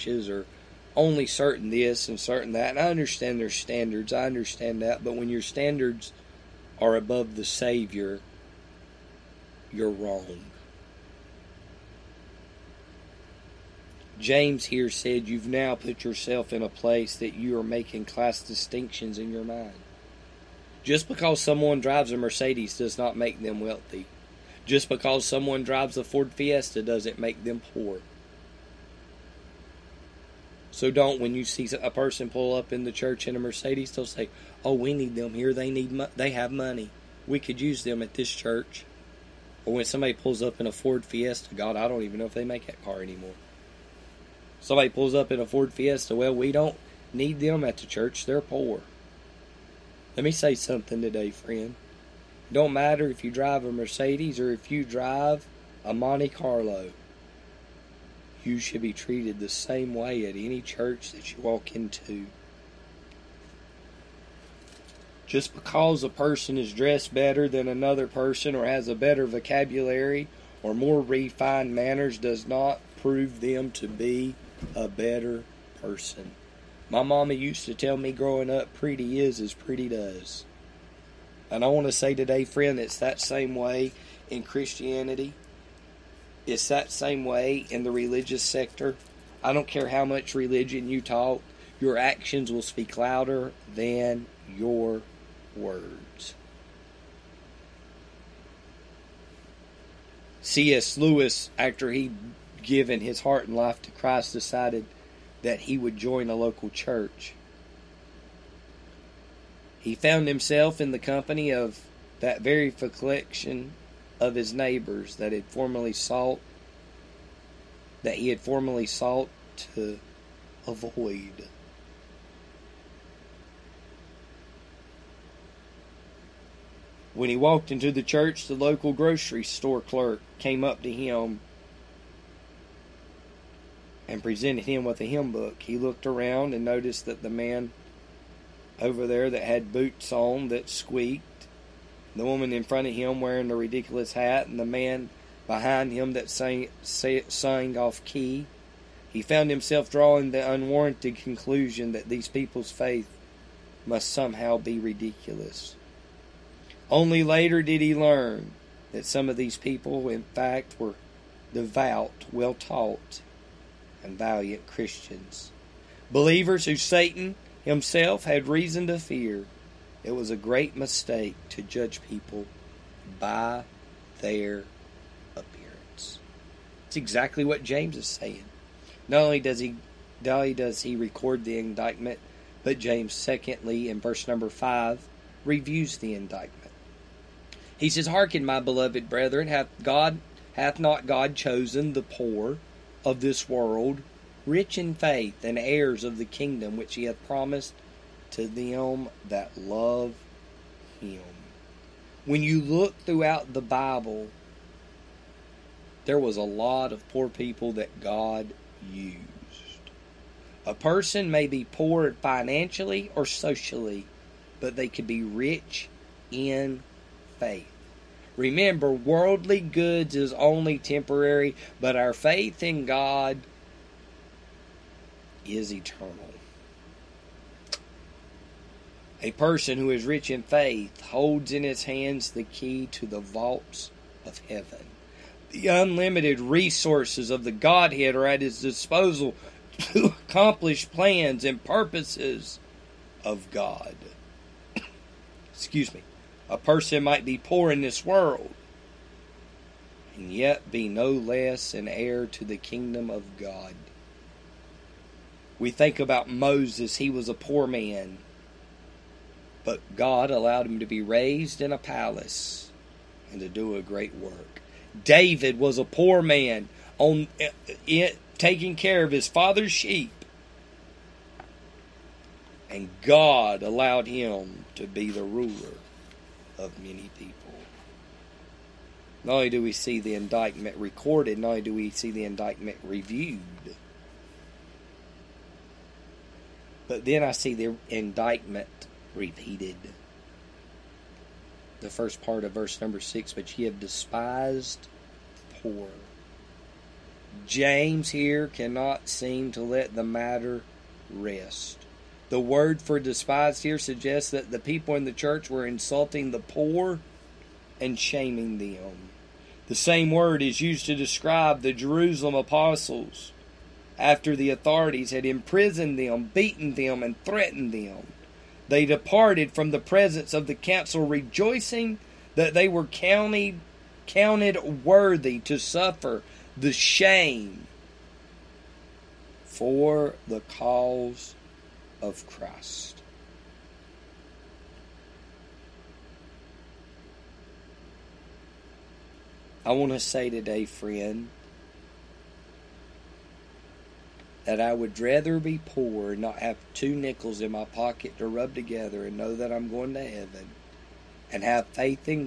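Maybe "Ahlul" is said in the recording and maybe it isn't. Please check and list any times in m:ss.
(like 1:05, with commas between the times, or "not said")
not said.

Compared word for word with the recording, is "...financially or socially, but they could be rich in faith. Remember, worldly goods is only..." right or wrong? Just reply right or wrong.
right.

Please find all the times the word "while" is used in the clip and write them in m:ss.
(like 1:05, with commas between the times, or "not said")
not said.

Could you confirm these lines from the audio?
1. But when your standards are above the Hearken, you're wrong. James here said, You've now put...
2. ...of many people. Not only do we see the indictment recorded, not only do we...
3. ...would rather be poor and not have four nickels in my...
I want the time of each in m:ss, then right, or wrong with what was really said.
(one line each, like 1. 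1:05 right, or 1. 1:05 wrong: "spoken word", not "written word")
1. 0:05 wrong: "Savior", not "Hearken"
2. 4:36 right
3. 5:44 wrong: "two", not "four".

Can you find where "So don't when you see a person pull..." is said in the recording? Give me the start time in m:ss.
0:30.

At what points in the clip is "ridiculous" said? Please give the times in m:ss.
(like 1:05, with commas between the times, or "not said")
2:23, 2:34.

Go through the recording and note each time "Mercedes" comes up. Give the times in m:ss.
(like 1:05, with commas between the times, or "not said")
0:22, 0:33, 0:53.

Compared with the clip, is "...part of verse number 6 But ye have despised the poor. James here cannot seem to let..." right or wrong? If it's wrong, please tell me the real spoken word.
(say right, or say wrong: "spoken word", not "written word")
right.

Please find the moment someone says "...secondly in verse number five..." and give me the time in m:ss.
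3:03.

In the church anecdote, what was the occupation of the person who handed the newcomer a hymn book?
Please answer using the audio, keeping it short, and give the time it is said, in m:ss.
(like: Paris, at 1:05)
grocery store clerk, at 2:08.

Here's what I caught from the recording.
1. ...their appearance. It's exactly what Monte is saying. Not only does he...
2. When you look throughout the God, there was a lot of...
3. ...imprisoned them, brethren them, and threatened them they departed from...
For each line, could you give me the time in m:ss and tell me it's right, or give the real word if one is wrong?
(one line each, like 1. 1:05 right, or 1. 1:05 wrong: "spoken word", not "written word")
1. 2:54 wrong: "James", not "Monte"
2. 3:22 wrong: "Bible", not "God"
3. 5:15 wrong: "beaten", not "brethren".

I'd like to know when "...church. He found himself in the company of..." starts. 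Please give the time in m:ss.
1:46.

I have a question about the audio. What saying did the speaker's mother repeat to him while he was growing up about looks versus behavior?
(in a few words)
Pretty is as pretty does.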